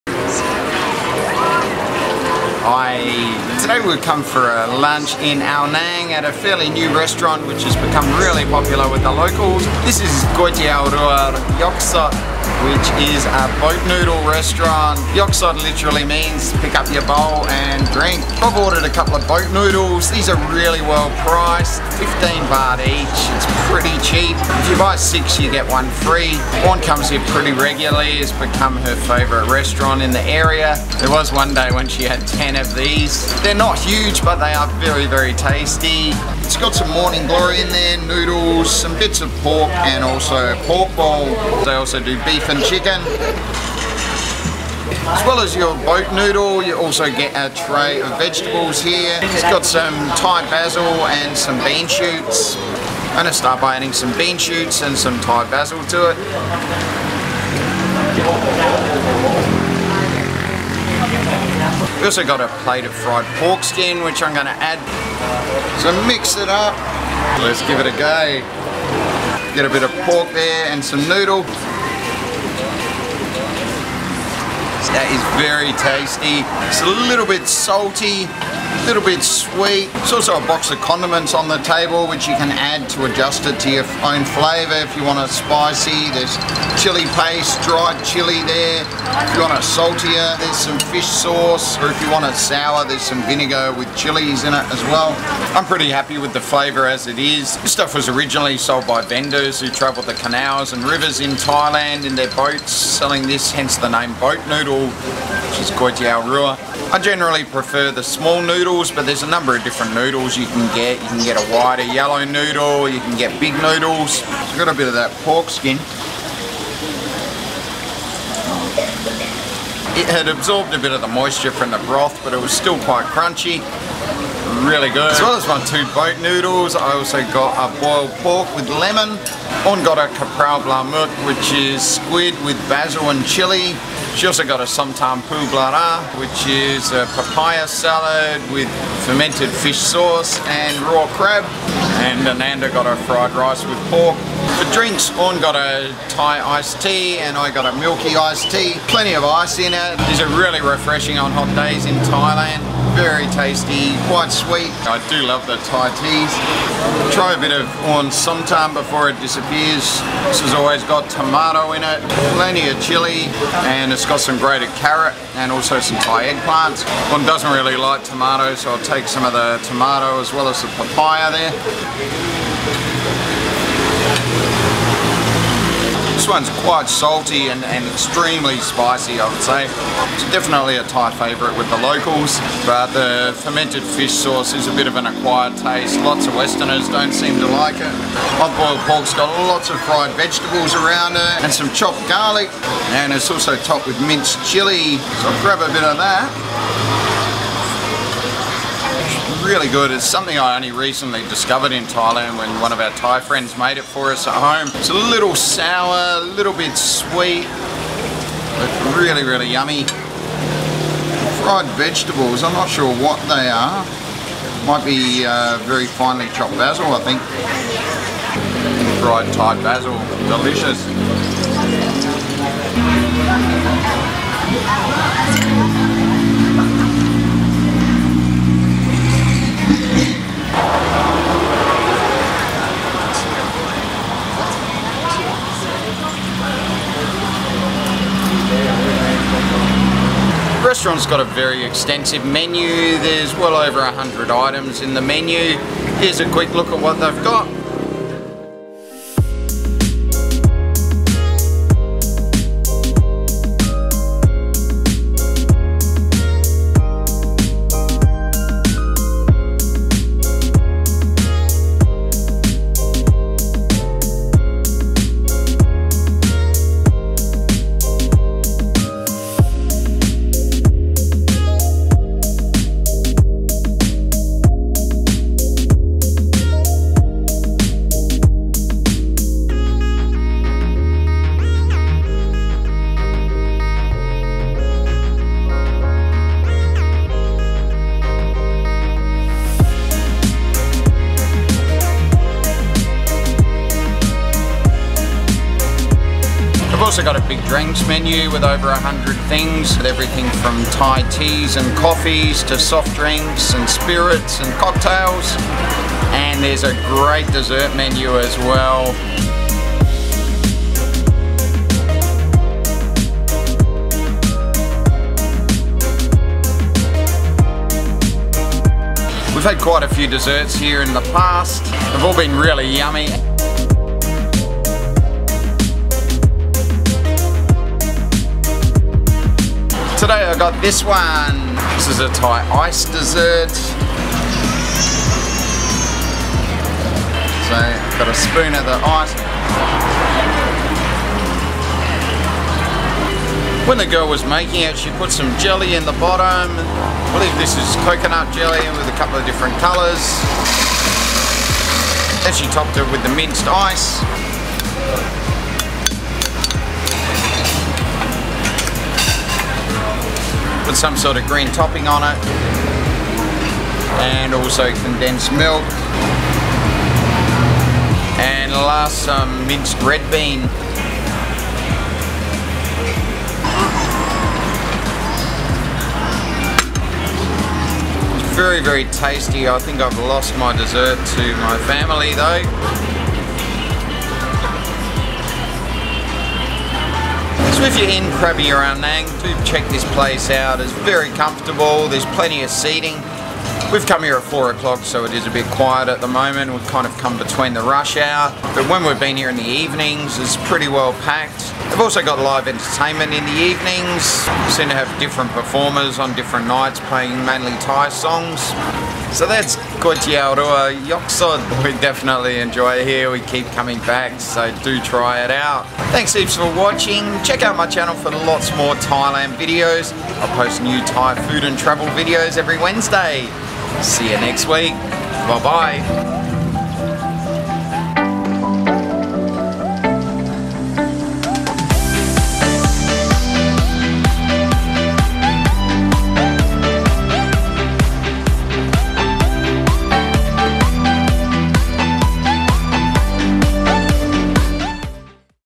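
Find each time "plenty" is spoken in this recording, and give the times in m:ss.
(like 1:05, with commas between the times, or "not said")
2:28, 2:42, 6:32.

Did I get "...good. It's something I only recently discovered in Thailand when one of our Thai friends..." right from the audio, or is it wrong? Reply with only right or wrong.
right.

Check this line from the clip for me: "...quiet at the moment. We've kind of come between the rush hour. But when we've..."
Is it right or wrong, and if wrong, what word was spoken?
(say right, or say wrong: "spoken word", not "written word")
right.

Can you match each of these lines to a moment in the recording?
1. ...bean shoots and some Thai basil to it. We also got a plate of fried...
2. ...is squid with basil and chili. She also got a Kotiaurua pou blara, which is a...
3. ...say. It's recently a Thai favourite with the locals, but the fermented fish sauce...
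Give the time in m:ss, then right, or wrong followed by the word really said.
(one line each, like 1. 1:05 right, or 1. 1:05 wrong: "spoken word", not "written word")
1. 0:54 right
2. 2:11 wrong: "Tam", not "Kotiaurua"
3. 2:59 wrong: "definitely", not "recently".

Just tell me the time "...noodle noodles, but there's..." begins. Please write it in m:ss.
1:48.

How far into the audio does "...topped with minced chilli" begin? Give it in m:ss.
3:13.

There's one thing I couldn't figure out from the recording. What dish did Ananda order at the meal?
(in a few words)
fried rice with pork.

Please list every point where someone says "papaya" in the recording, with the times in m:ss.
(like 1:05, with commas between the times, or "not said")
2:17, 2:50.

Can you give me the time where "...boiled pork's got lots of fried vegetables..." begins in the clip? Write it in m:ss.
3:08.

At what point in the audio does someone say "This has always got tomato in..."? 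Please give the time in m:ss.
2:40.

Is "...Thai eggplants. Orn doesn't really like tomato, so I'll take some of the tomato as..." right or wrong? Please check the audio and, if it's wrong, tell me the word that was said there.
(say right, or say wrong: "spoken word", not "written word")
right.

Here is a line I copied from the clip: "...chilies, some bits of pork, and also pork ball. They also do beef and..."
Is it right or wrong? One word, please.
wrong.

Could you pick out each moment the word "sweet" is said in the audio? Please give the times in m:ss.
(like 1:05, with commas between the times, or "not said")
1:19, 2:34, 3:26.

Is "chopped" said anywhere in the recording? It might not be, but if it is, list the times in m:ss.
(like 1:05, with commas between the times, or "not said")
3:11, 3:36.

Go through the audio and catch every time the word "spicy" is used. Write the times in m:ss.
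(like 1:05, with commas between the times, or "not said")
1:25, 2:58.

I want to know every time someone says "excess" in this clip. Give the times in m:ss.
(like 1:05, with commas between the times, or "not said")
not said.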